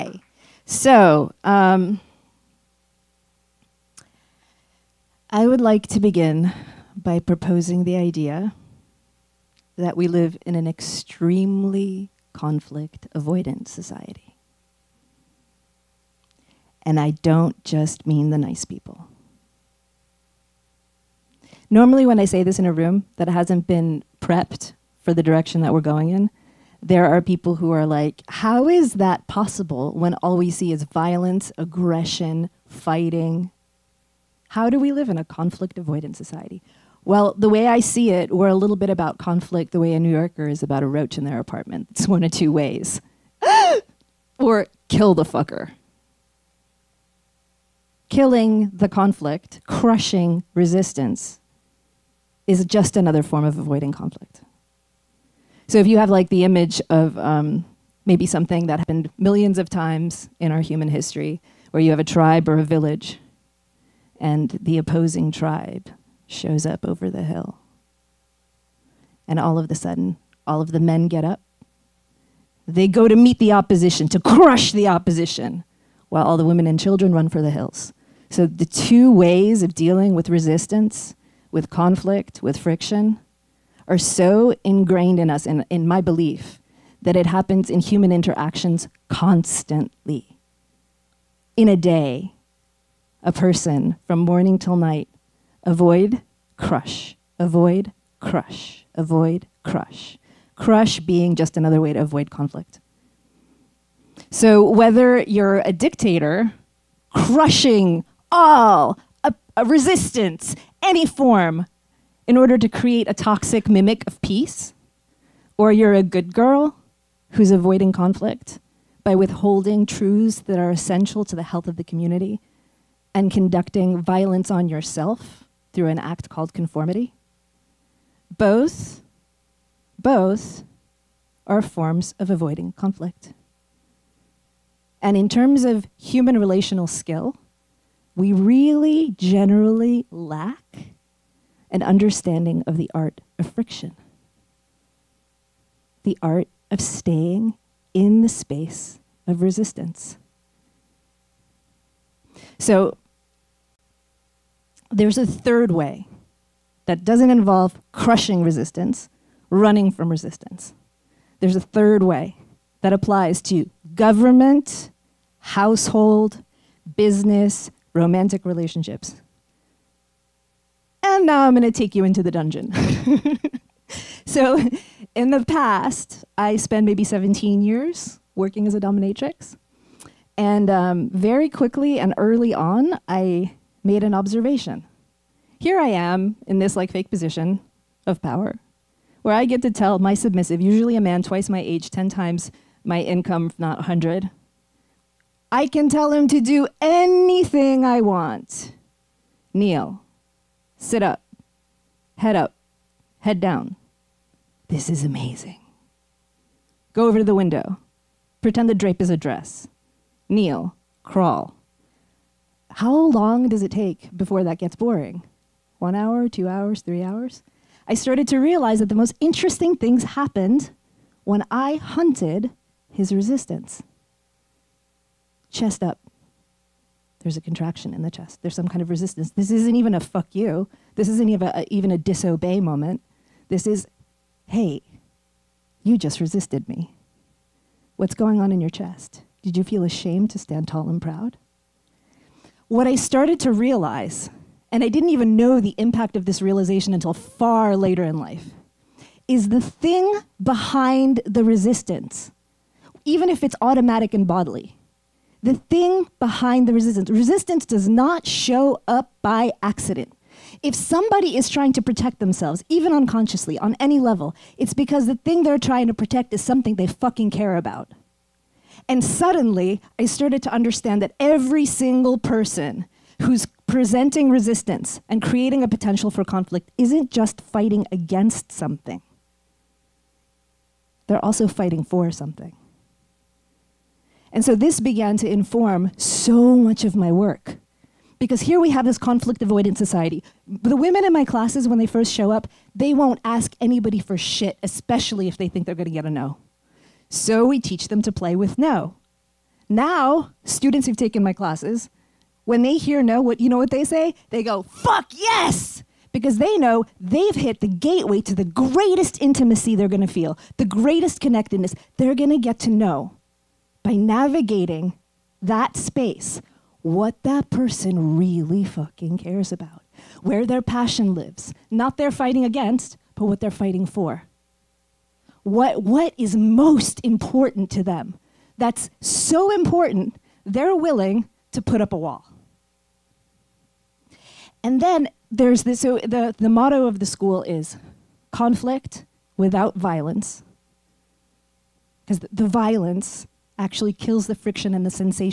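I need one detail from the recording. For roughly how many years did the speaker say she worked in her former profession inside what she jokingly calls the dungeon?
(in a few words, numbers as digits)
17.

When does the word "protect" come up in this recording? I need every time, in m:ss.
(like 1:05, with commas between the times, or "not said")
4:21, 4:25.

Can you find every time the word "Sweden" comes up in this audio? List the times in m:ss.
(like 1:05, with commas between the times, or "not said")
not said.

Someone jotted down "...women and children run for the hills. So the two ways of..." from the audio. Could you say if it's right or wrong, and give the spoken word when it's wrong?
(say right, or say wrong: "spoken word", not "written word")
right.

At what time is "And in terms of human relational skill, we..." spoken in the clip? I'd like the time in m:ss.
2:15.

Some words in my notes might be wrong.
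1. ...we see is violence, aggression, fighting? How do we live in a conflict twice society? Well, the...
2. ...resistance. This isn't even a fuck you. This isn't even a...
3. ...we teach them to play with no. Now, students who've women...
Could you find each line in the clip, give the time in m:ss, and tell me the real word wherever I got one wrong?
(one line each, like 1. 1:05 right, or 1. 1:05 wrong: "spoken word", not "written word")
1. 0:30 wrong: "avoidance", not "twice"
2. 3:48 right
3. 4:57 wrong: "taken", not "women".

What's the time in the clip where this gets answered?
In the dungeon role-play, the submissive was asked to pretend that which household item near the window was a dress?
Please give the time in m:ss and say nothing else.
3:28.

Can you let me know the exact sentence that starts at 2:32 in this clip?
So there's a third way that doesn't involve crushing resistance, running from resistance.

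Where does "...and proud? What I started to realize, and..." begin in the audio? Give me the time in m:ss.
4:00.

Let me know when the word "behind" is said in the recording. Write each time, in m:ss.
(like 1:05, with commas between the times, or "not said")
4:10, 4:16.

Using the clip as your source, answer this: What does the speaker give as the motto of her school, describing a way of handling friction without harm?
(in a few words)
Conflict without violence.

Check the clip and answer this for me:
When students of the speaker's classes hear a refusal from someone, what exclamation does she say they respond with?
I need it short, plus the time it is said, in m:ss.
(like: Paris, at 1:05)
Fuck yes, at 5:04.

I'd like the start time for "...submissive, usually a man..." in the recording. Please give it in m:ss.
3:10.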